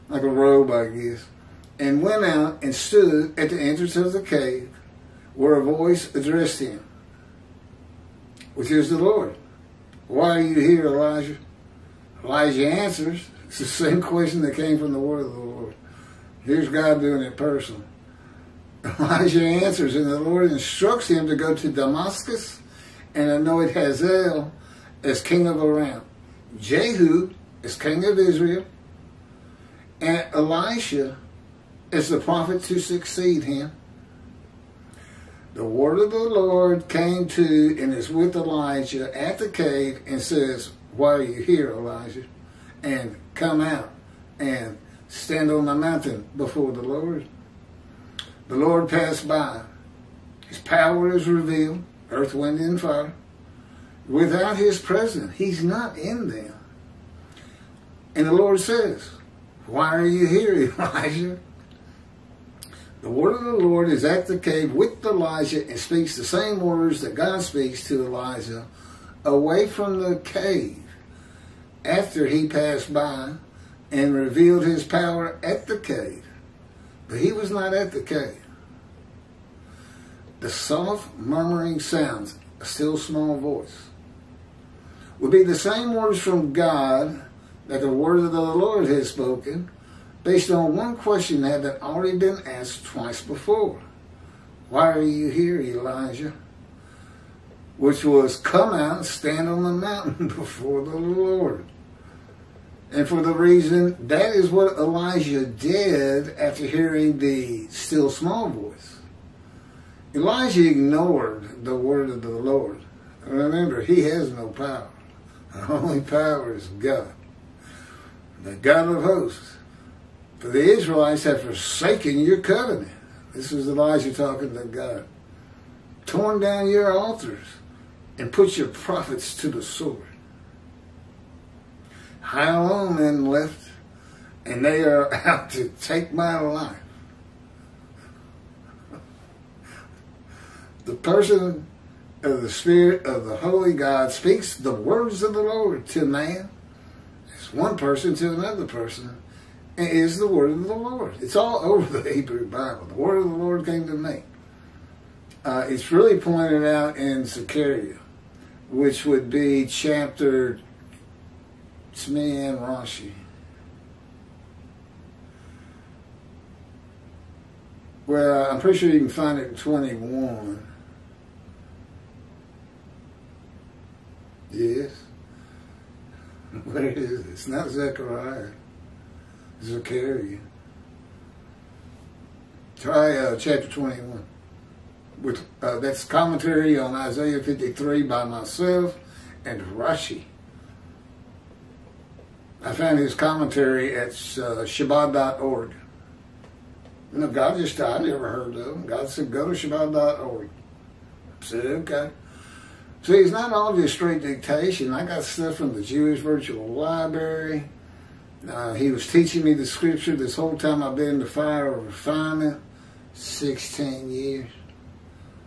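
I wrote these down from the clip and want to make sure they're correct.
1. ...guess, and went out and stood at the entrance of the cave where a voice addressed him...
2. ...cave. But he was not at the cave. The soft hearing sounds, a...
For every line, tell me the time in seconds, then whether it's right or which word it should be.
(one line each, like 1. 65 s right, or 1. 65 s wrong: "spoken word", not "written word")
1. 0 s right
2. 75 s wrong: "murmuring", not "hearing".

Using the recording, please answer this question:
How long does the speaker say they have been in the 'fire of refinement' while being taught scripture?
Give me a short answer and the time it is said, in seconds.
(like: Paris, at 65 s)
16 years, at 213 s.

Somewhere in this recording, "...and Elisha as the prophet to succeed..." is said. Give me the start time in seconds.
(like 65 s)
30 s.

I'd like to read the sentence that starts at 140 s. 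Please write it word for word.
the person of the Spirit of the Holy God speaks the words of the Lord to man.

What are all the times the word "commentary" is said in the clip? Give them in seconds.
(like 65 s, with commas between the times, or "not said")
186 s, 193 s.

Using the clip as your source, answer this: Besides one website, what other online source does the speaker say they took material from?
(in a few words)
Jewish Virtual Library.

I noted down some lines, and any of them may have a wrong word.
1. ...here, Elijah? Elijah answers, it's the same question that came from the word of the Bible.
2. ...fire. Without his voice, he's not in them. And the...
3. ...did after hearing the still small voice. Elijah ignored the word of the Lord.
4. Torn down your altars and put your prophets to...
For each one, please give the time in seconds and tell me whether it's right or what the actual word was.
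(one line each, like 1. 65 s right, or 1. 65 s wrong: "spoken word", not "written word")
1. 10 s wrong: "Lord", not "Bible"
2. 52 s wrong: "presence", not "voice"
3. 105 s right
4. 126 s right.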